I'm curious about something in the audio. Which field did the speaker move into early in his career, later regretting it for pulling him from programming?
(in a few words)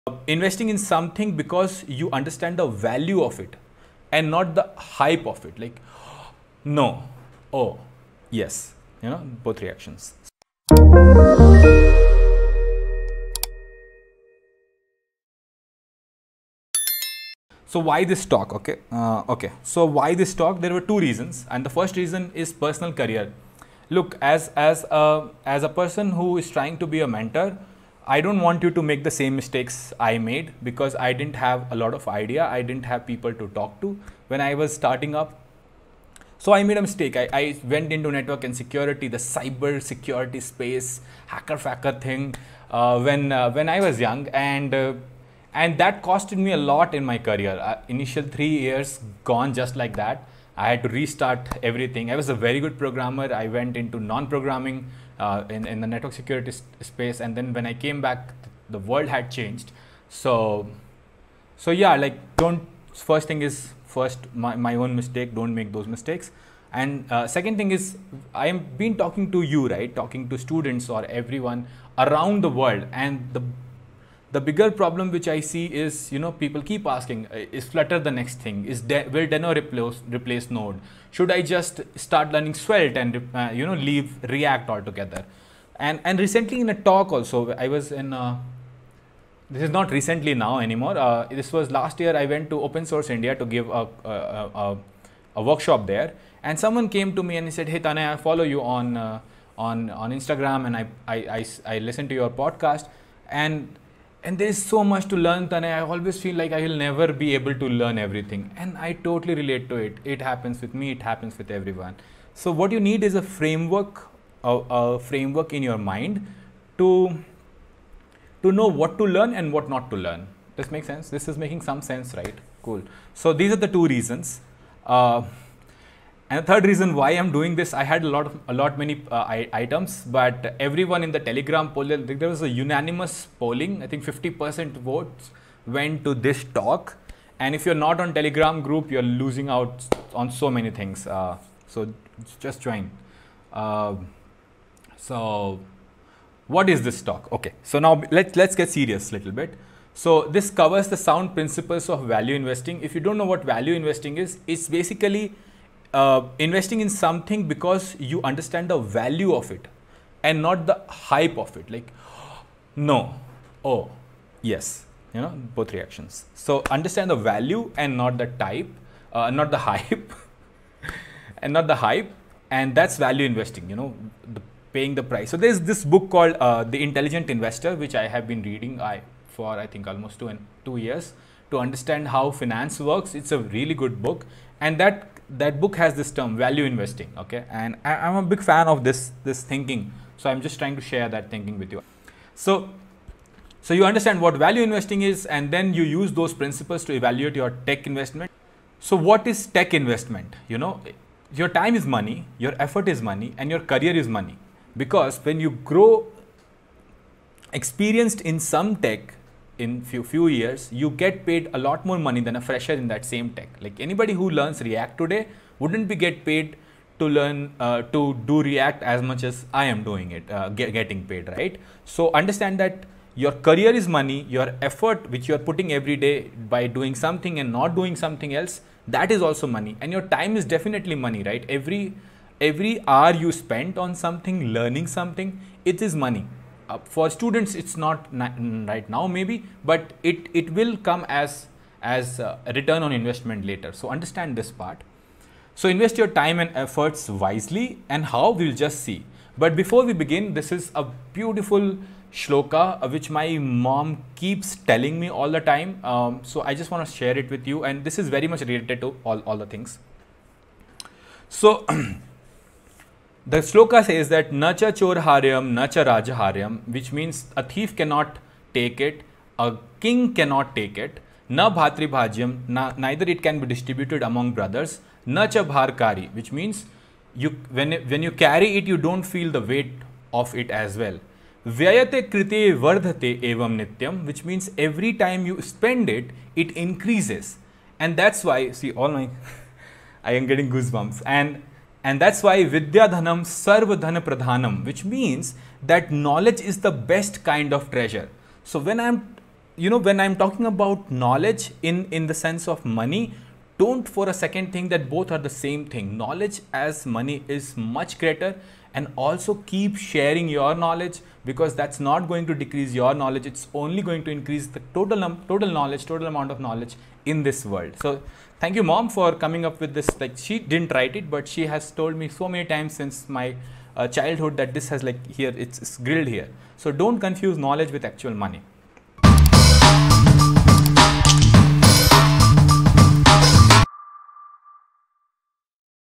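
network and security.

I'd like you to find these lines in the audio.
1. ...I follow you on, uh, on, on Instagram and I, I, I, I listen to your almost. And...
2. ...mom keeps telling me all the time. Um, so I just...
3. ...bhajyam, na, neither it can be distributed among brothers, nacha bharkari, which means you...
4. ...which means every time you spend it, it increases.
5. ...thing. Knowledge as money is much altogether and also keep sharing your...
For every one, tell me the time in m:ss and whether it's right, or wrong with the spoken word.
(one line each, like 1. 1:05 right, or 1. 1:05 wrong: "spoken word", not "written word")
1. 1:38 wrong: "podcast", not "almost"
2. 4:13 right
3. 4:31 right
4. 4:44 right
5. 5:05 wrong: "greater", not "altogether".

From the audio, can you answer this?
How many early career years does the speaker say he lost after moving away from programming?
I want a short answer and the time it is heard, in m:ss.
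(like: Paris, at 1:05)
3, at 0:48.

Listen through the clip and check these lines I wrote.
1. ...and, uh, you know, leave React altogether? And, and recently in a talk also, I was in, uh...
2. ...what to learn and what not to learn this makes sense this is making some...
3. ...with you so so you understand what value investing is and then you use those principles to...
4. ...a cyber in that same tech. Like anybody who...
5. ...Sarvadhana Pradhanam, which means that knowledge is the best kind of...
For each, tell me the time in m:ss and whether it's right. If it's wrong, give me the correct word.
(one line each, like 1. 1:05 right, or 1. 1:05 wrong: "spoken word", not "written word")
1. 1:22 right
2. 1:58 right
3. 3:11 right
4. 3:32 wrong: "fresher", not "cyber"
5. 4:53 right.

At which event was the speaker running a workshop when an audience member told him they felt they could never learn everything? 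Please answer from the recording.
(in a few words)
Open Source India.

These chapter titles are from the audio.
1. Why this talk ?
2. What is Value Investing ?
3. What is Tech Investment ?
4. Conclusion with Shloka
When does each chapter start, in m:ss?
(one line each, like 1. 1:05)
1. 0:17
2. 2:25
3. 3:18
4. 4:09.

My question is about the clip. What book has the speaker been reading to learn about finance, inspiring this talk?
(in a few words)
The Intelligent Investor.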